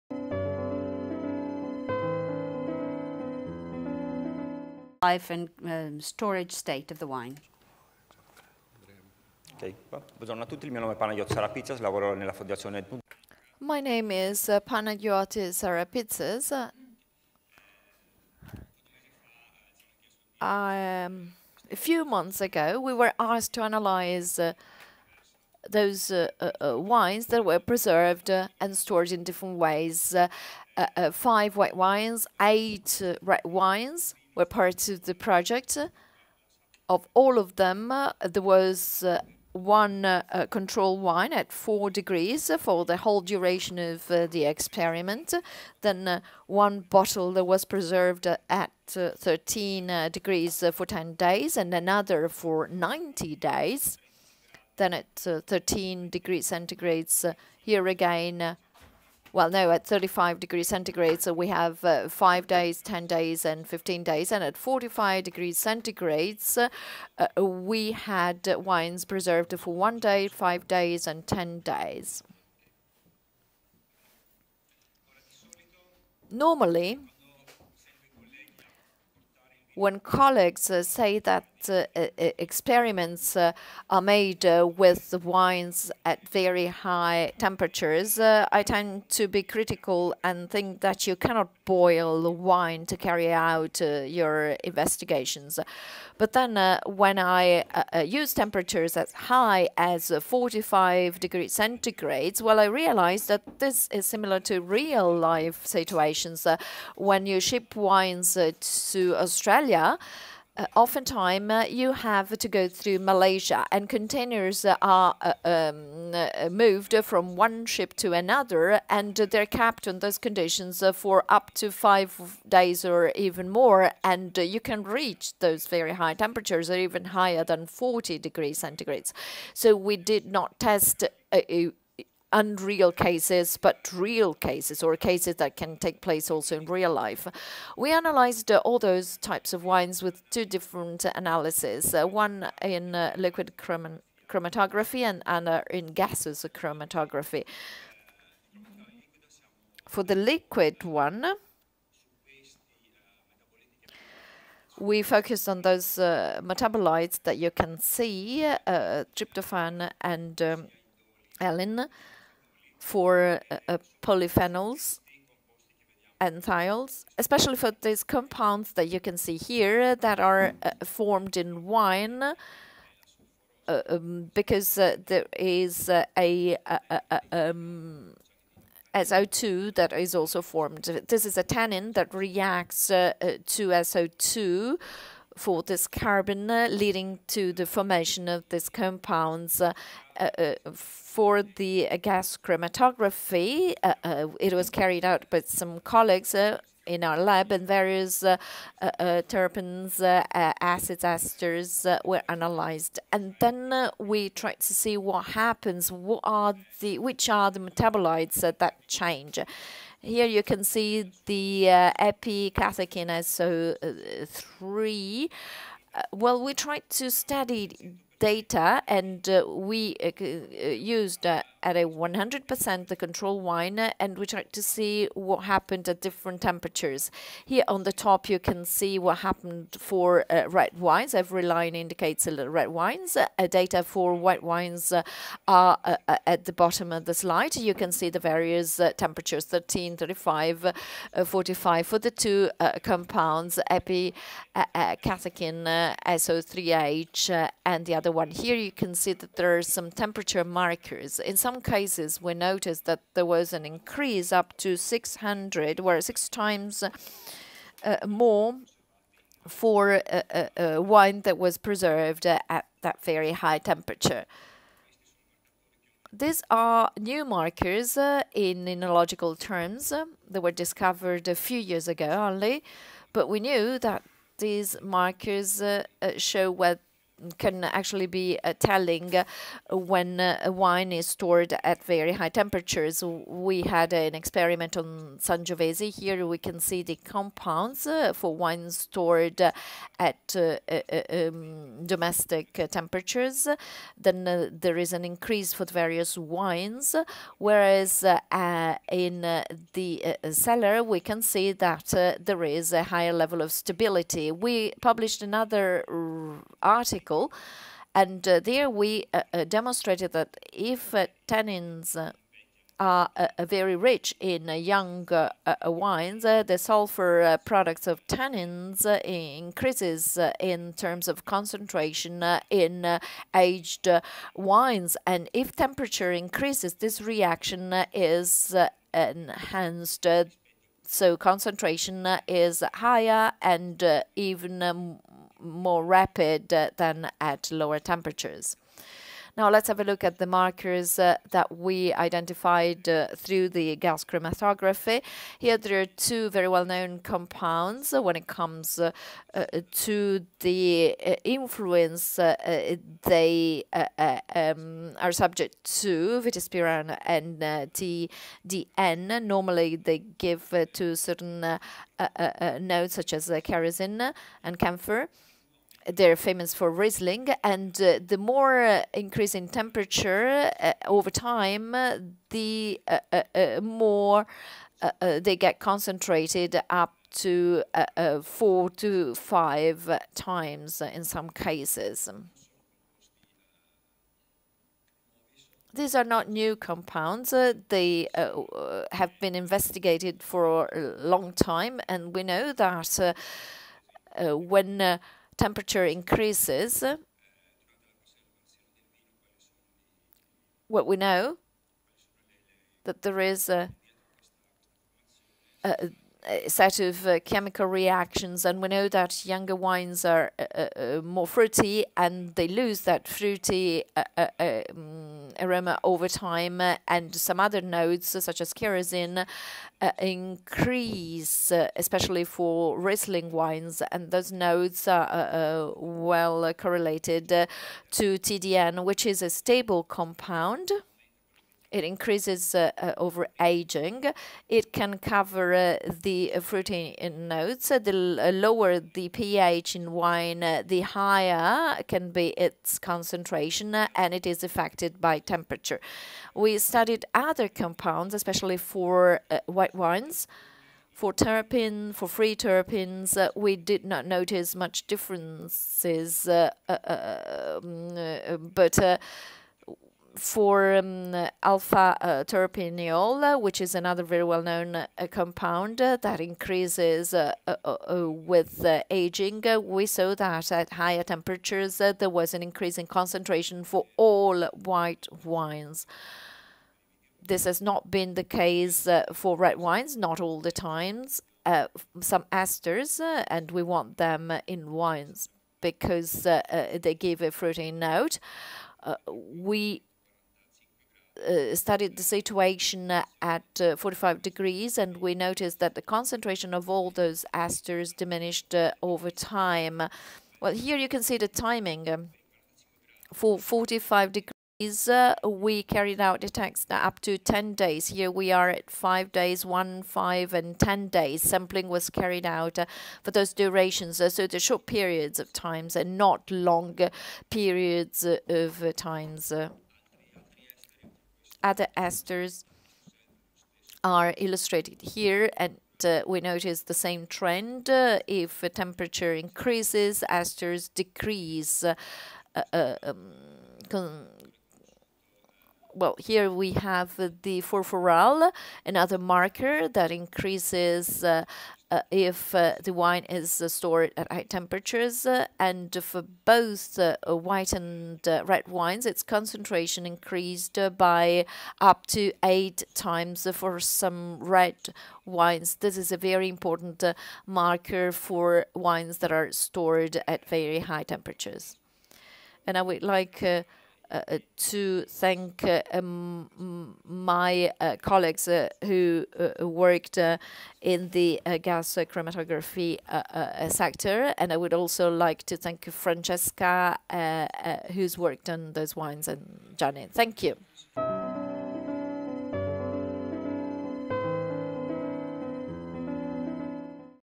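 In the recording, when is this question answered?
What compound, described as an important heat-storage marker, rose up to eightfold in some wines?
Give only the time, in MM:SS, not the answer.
08:57.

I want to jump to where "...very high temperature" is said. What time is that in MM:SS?
04:23.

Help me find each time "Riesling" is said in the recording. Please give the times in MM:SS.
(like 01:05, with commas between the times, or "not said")
06:06, 07:02.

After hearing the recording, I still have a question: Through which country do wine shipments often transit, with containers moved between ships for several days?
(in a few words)
Malaysia.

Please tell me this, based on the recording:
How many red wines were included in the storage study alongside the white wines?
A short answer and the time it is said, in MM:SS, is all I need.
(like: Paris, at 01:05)
8, at 00:32.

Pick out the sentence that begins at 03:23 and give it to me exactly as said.
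And then we tried to see what happens, what are the, which are the metabolites that change.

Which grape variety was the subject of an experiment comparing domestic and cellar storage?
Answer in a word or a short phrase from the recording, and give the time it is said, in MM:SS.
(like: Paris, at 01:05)
Sangiovese, at 04:45.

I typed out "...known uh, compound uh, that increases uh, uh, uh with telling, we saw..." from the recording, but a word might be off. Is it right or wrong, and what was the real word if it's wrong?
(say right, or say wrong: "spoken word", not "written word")
wrong: "aging", not "telling".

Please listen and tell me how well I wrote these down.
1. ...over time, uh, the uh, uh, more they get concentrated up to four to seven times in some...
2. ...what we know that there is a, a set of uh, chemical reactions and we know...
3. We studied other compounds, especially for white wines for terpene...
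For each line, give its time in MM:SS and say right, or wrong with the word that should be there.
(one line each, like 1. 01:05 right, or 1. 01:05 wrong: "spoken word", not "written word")
1. 06:10 wrong: "five", not "seven"
2. 06:40 right
3. 07:26 right.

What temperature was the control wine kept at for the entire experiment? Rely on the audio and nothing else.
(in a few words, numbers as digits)
4 degrees.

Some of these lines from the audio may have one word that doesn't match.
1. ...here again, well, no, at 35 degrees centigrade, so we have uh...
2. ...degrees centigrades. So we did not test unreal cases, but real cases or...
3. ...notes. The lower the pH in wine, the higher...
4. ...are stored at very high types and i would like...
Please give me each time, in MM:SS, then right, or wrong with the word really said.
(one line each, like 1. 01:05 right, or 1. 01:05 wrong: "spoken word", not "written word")
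1. 00:57 right
2. 02:08 right
3. 07:17 right
4. 09:19 wrong: "temperatures", not "types".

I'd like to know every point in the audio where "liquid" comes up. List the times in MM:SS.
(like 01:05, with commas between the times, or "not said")
02:23, 02:30.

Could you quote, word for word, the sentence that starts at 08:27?
Here we are at 5 days, 1, 5, and 10 days.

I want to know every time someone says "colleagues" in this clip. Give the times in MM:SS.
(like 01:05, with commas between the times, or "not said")
01:20, 03:15, 09:27.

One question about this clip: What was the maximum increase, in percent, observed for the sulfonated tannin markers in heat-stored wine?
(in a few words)
600.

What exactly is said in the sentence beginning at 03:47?
Here on the top you can see what happened for uh, red wines.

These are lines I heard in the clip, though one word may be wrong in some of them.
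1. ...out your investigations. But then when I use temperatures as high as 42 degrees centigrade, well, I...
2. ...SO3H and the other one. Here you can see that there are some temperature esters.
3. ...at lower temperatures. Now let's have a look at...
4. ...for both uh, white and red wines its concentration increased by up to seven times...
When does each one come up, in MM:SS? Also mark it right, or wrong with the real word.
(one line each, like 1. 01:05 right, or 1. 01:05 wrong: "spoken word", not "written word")
1. 01:33 wrong: "45", not "42"
2. 04:06 wrong: "markers", not "esters"
3. 05:37 right
4. 09:05 wrong: "eight", not "seven".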